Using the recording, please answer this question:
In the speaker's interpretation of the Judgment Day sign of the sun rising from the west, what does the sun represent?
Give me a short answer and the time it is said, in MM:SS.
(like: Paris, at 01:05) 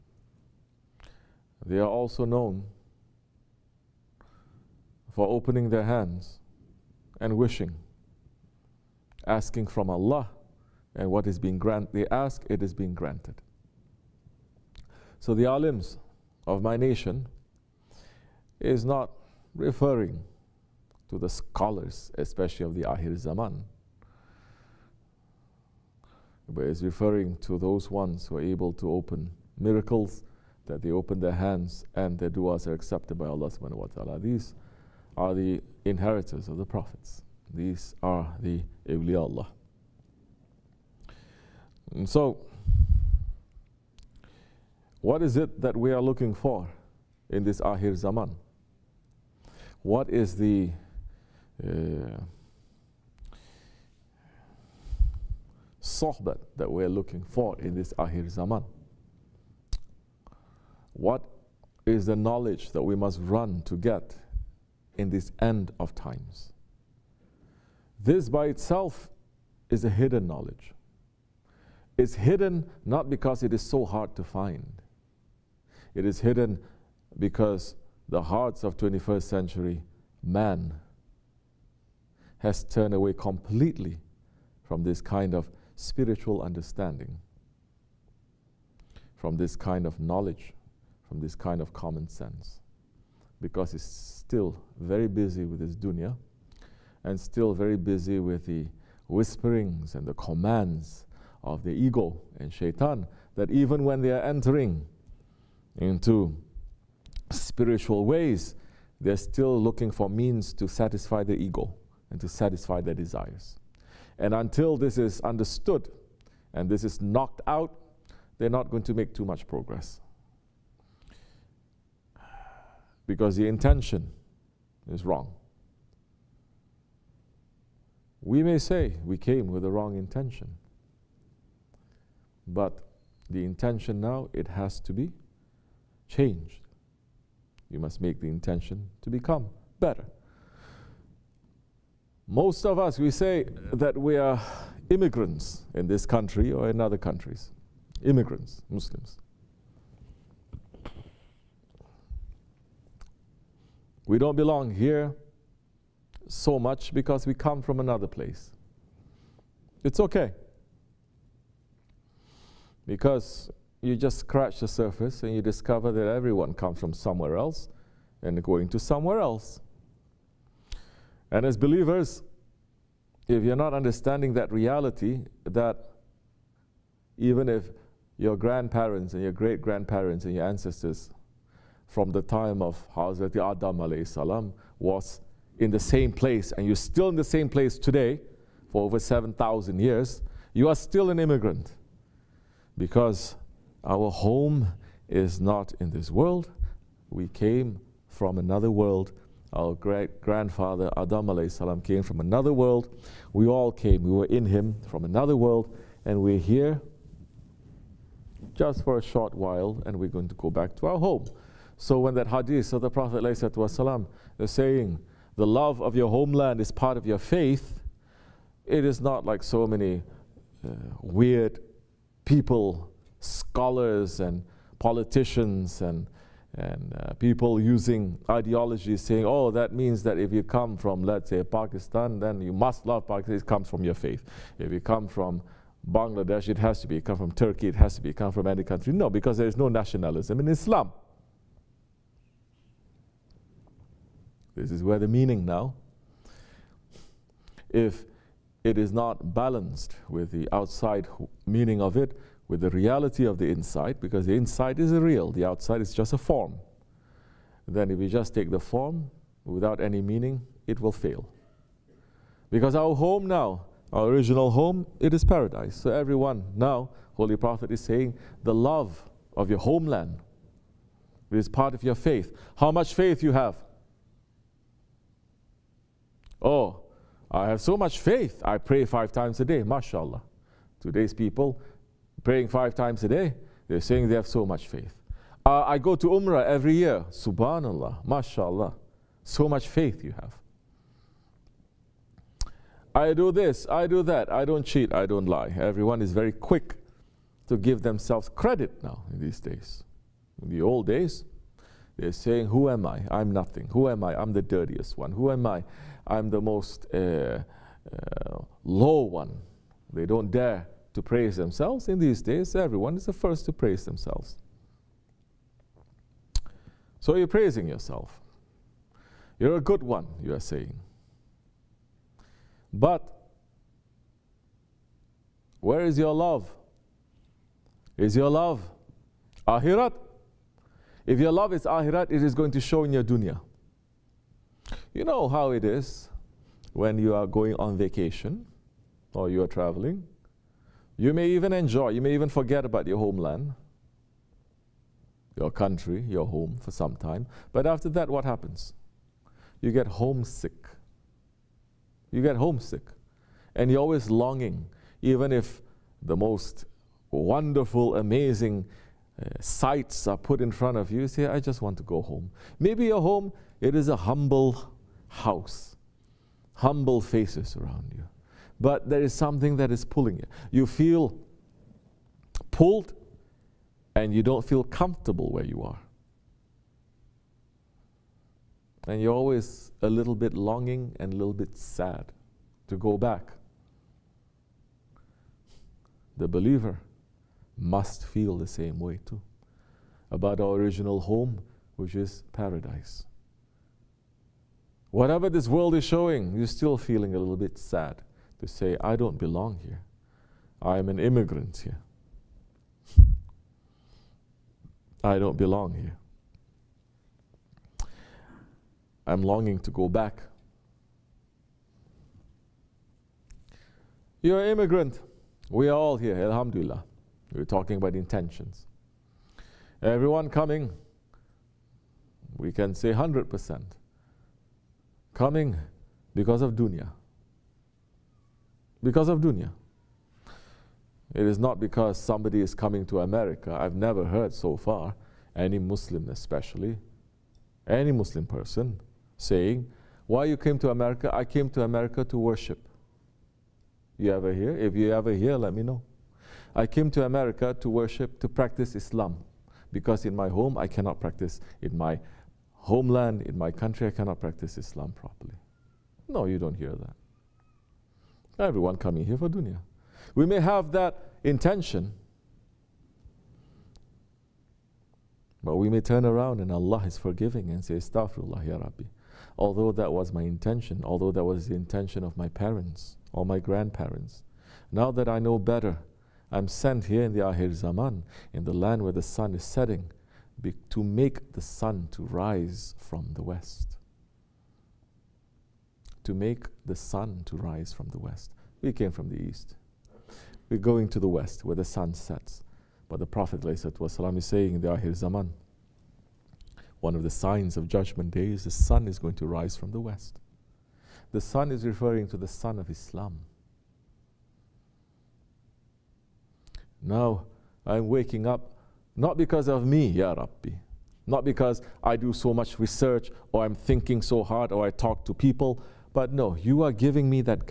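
the sun of Islam, at 08:22.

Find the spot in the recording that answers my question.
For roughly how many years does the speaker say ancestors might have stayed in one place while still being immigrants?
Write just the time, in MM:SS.
03:08.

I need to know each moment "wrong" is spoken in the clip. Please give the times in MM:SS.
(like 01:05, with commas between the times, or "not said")
02:05, 02:09.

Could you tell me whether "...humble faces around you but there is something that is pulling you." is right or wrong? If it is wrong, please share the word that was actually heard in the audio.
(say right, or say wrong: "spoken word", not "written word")
right.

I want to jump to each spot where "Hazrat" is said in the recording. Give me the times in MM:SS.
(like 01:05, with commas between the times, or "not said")
03:02.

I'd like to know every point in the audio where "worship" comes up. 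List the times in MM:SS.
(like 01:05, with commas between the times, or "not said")
07:22, 07:27.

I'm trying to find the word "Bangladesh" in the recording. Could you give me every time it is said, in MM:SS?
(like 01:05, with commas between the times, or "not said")
03:55.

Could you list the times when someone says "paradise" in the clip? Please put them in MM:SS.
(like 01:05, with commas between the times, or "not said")
04:25, 06:32.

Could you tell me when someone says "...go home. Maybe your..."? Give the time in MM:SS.
06:01.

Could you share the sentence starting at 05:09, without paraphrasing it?
They don't dare to praise themselves.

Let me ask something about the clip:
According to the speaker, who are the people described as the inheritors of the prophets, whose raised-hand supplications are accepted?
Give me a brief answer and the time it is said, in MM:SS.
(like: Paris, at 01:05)
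the awliya Allah, at 00:38.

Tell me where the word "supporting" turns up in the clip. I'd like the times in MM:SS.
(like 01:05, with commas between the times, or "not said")
not said.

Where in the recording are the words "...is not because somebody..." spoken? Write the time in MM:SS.
07:11.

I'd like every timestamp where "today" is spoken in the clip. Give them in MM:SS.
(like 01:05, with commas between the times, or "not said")
03:07, 04:40.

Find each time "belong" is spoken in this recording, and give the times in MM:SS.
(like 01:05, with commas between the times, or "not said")
02:34, 06:39, 06:45.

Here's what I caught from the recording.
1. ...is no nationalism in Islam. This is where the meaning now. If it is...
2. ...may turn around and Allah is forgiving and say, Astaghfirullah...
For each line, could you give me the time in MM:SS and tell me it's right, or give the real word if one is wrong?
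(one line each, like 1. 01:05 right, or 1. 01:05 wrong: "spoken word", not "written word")
1. 03:59 right
2. 07:45 right.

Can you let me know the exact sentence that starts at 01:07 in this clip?
This by itself is a hidden knowledge.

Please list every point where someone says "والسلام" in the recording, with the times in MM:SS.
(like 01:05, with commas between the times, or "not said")
03:33.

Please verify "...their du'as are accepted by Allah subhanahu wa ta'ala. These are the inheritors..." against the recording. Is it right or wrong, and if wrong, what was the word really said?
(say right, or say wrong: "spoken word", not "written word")
right.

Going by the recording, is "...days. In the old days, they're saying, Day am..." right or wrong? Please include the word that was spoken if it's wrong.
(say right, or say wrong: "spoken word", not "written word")
wrong: "Who", not "Day".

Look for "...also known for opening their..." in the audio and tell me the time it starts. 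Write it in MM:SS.
00:01.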